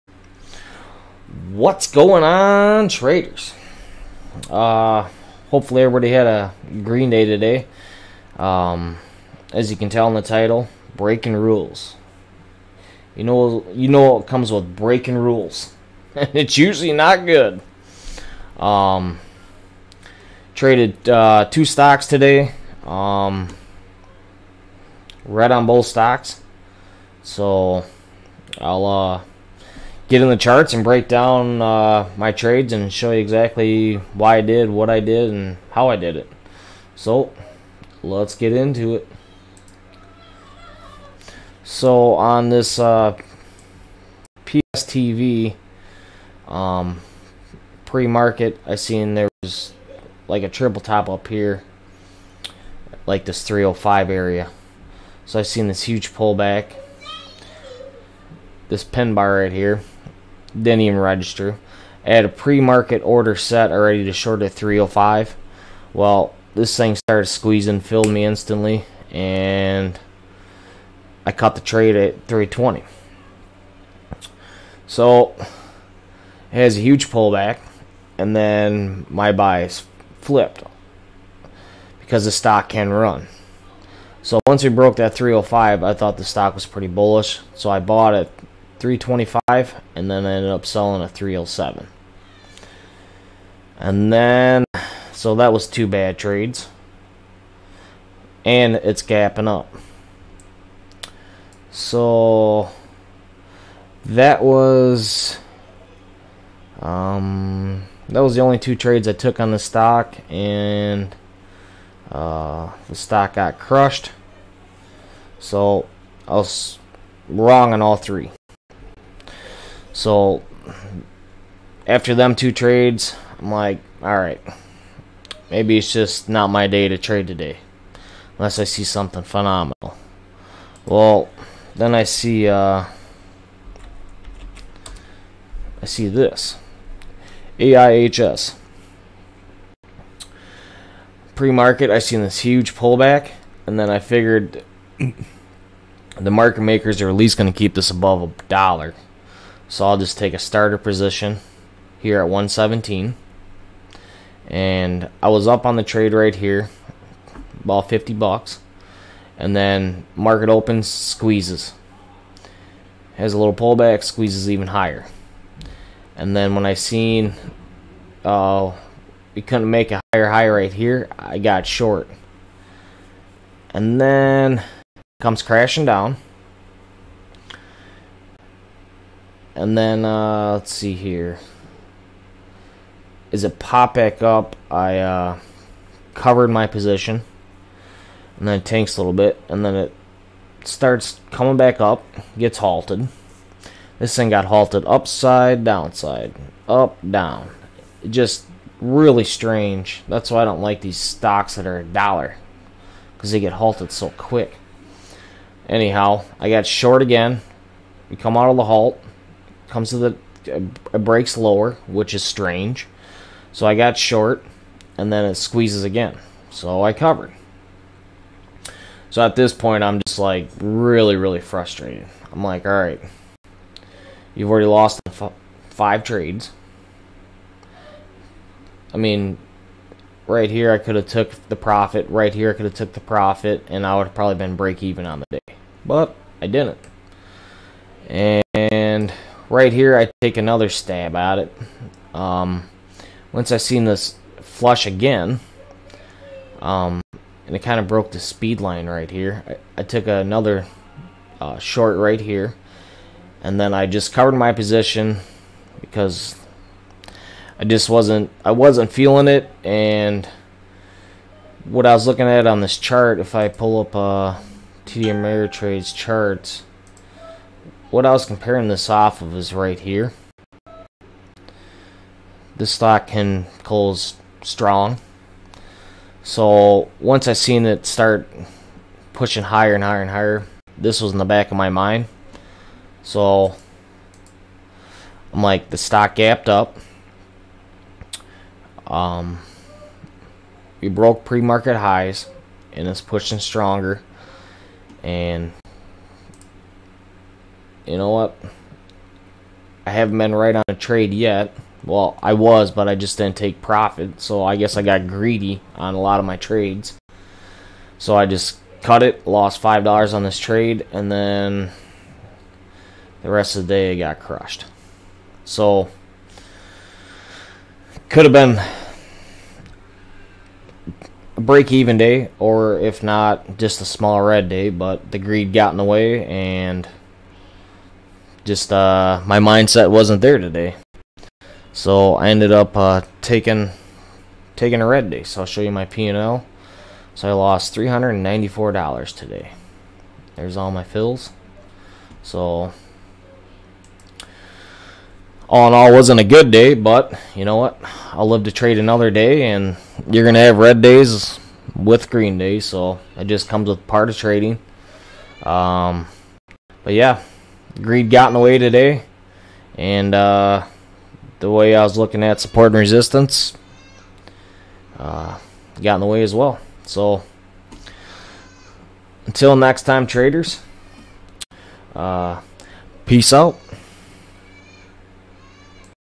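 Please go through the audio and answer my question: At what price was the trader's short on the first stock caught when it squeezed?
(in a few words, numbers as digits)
320.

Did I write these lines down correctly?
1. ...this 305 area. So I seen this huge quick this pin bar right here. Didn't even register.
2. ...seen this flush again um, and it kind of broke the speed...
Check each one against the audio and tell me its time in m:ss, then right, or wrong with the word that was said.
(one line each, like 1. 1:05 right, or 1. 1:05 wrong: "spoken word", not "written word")
1. 0:53 wrong: "pullback", not "quick"
2. 4:03 right.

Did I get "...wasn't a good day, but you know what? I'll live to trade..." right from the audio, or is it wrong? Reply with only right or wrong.
right.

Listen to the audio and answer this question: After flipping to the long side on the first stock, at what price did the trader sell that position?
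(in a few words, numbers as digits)
307.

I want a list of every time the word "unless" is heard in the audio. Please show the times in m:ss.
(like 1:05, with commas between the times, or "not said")
2:08.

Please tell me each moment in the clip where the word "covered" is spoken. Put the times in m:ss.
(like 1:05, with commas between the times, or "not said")
3:06, 3:36, 4:14.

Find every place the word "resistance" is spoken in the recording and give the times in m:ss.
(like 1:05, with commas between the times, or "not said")
6:02.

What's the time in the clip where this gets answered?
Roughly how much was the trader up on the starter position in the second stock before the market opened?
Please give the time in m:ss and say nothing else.
2:37.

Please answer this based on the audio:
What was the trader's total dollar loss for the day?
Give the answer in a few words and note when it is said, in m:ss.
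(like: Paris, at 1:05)
$394, at 5:37.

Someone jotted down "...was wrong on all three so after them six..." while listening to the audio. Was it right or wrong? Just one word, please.
wrong.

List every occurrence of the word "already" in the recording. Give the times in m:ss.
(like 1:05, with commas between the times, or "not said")
1:03, 3:44.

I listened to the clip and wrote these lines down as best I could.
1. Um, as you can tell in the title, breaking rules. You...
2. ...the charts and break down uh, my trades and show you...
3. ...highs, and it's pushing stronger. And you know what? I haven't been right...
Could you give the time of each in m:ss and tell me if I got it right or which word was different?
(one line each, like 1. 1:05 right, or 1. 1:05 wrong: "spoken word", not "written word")
1. 0:08 right
2. 0:30 right
3. 4:51 right.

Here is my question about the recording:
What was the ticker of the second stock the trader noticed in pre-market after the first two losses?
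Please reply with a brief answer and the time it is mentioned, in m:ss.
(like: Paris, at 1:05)
AIHS, at 2:17.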